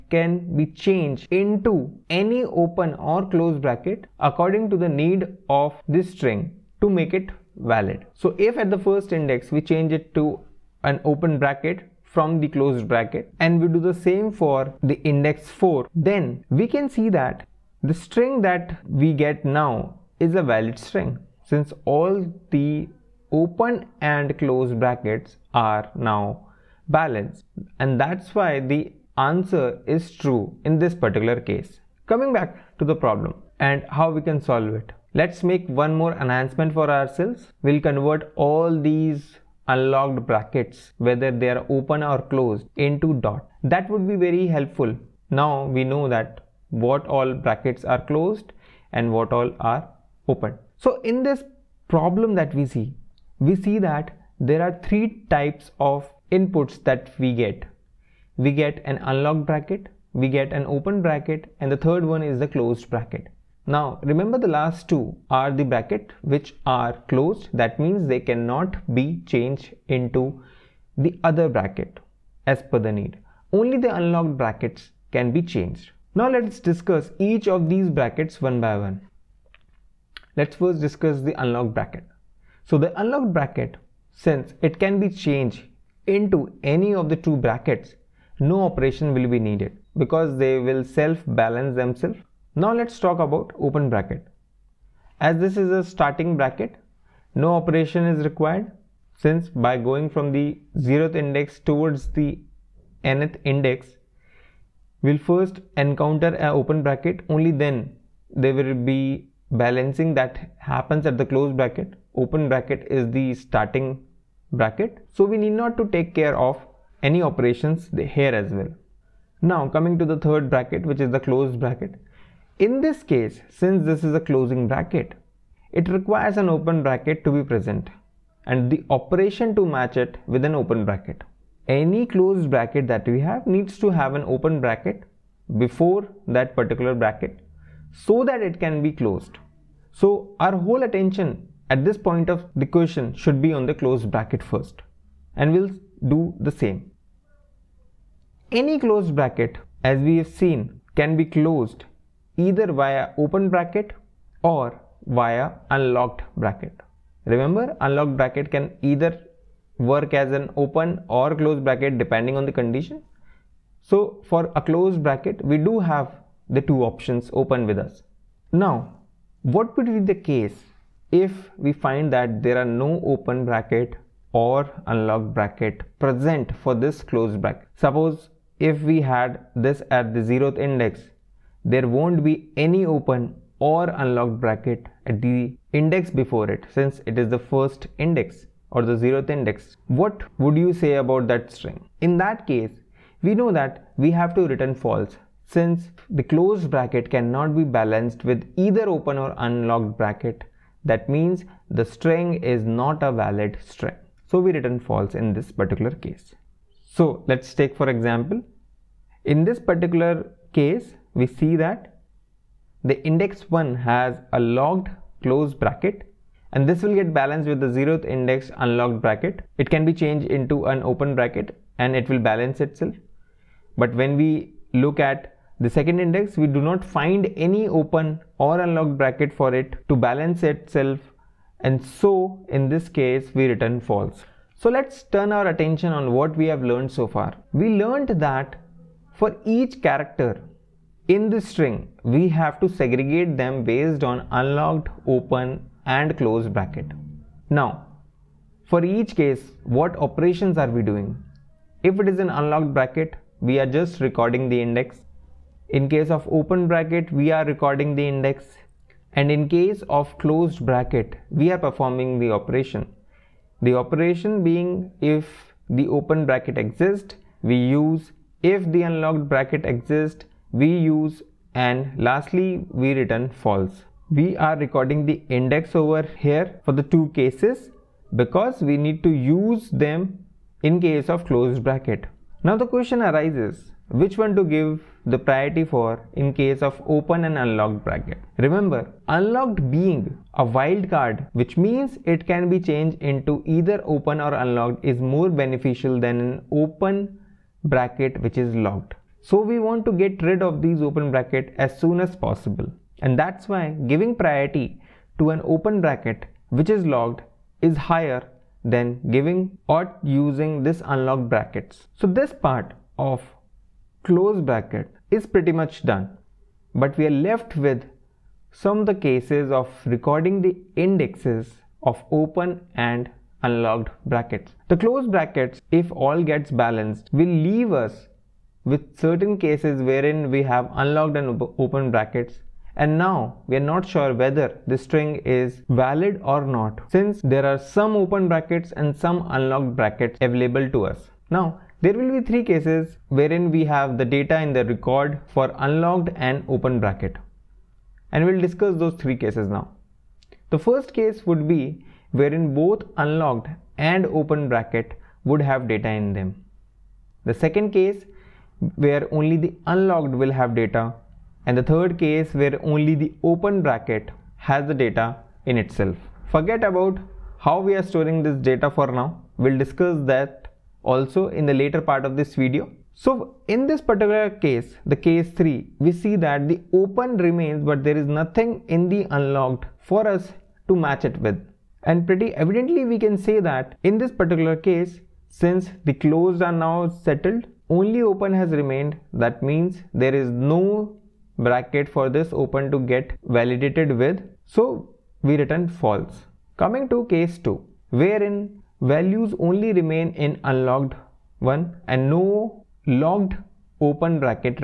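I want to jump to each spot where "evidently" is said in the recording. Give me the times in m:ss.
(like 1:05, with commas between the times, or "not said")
6:22.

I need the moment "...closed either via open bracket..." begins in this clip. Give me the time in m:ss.
2:31.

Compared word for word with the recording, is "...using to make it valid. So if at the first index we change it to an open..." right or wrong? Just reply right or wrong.
wrong.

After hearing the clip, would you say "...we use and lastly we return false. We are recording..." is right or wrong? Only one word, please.
right.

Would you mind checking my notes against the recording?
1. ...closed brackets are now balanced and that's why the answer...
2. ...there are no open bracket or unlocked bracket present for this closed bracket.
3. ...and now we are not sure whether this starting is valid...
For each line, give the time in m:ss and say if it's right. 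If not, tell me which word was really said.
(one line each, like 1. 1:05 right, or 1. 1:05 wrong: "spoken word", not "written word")
1. 0:24 right
2. 2:52 right
3. 5:32 wrong: "string", not "starting".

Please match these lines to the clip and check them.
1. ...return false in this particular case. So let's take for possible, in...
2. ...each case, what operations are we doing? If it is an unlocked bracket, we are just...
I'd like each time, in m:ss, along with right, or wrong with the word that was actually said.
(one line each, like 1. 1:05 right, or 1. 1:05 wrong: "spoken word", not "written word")
1. 3:24 wrong: "example", not "possible"
2. 4:08 right.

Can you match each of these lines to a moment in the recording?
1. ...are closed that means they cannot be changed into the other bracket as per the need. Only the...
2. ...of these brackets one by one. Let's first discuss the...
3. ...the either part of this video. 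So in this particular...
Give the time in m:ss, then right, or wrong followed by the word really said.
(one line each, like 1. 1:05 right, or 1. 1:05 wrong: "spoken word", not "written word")
1. 1:06 right
2. 1:17 right
3. 6:11 wrong: "later", not "either".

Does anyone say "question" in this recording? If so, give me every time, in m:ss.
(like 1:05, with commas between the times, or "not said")
2:22, 4:42.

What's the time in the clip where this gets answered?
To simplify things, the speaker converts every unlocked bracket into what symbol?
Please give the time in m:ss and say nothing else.
0:43.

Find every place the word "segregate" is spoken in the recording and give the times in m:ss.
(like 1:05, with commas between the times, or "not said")
4:02.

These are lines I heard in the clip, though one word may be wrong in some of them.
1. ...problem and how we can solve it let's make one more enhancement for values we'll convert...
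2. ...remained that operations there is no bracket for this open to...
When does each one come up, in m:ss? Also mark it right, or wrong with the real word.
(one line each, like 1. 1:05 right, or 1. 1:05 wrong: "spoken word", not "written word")
1. 0:33 wrong: "ourselves", not "values"
2. 6:28 wrong: "means", not "operations".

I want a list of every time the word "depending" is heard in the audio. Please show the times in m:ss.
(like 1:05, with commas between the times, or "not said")
2:41.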